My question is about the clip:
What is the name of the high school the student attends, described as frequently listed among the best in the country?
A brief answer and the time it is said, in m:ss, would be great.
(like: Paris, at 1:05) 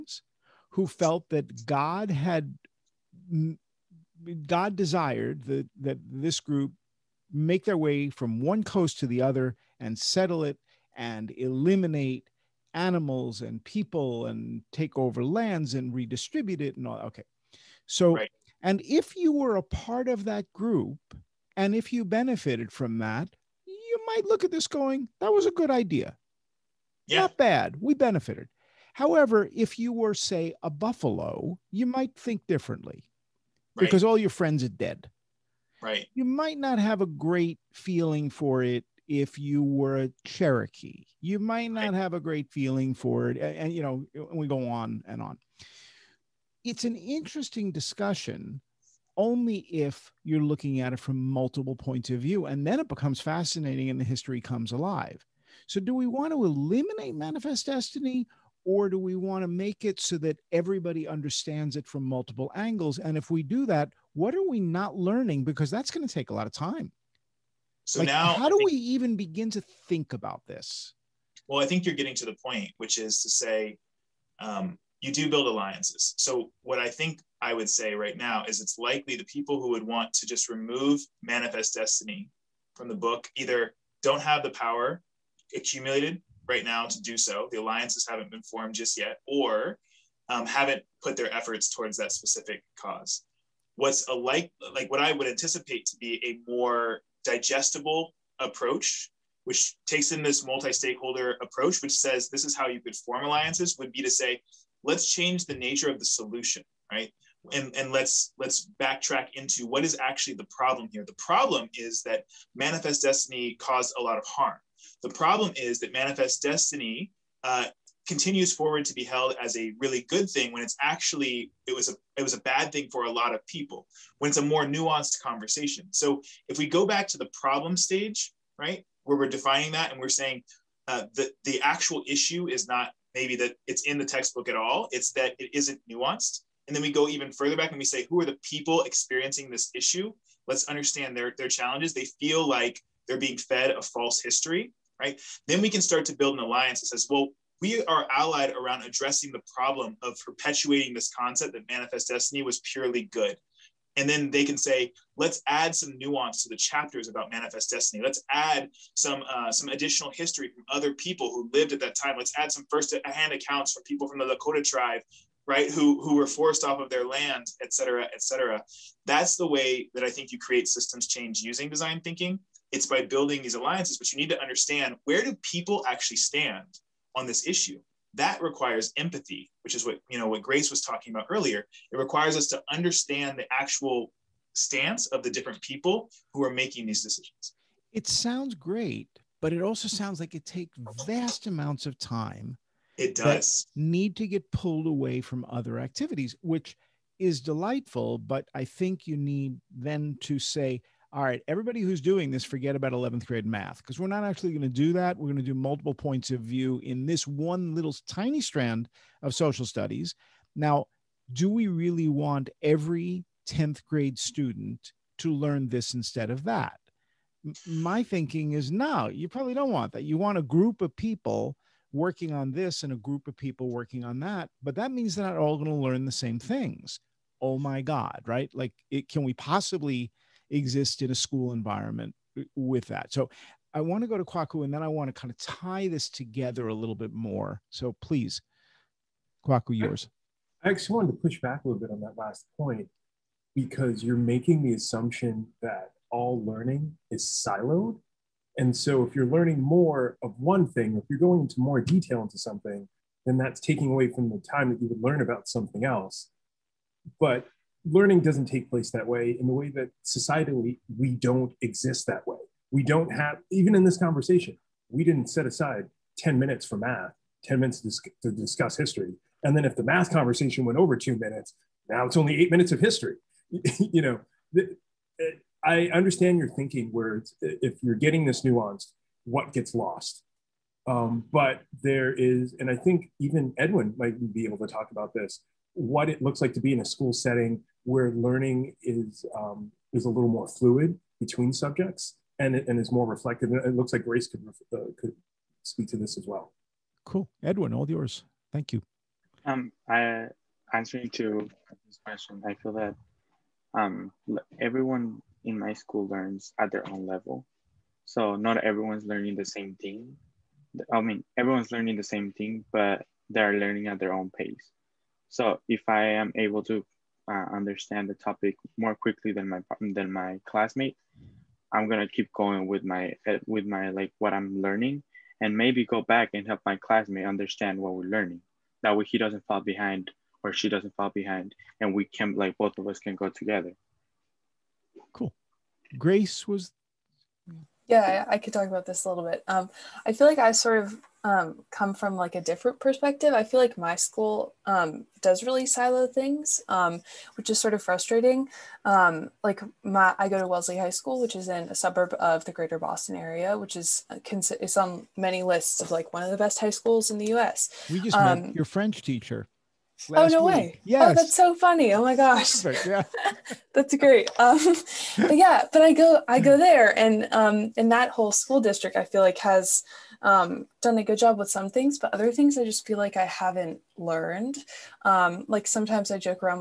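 Wellesley High School, at 5:50.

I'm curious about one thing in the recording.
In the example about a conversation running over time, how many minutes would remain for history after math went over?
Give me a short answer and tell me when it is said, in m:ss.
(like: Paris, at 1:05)
8 minutes, at 4:32.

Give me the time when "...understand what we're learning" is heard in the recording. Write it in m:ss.
5:27.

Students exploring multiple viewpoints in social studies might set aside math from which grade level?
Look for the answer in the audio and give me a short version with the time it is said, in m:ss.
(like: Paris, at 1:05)
11th grade, at 3:22.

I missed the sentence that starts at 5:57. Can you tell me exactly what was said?
We just um, met your French teacher oh no week.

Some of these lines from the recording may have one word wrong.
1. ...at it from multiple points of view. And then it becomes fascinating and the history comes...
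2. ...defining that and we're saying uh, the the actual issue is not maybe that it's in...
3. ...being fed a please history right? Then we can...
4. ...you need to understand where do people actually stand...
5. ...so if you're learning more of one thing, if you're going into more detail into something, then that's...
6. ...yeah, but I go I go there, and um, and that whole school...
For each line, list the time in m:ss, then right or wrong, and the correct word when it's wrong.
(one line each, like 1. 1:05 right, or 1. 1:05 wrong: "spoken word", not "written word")
1. 0:50 right
2. 2:09 right
3. 2:23 wrong: "false", not "please"
4. 2:54 right
5. 4:08 right
6. 6:05 right.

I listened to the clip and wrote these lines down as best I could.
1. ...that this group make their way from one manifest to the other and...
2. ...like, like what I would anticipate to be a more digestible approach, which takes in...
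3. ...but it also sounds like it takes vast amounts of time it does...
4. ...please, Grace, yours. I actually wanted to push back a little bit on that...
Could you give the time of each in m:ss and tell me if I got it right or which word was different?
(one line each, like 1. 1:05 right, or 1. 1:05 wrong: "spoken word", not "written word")
1. 0:05 wrong: "coast", not "manifest"
2. 1:34 right
3. 3:09 right
4. 3:58 wrong: "Kwaku", not "Grace".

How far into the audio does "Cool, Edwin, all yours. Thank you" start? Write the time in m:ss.
4:57.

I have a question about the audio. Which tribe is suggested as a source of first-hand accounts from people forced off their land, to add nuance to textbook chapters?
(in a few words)
Lakota.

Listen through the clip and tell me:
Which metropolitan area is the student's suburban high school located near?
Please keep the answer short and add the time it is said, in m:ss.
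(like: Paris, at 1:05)
Greater Boston, at 5:52.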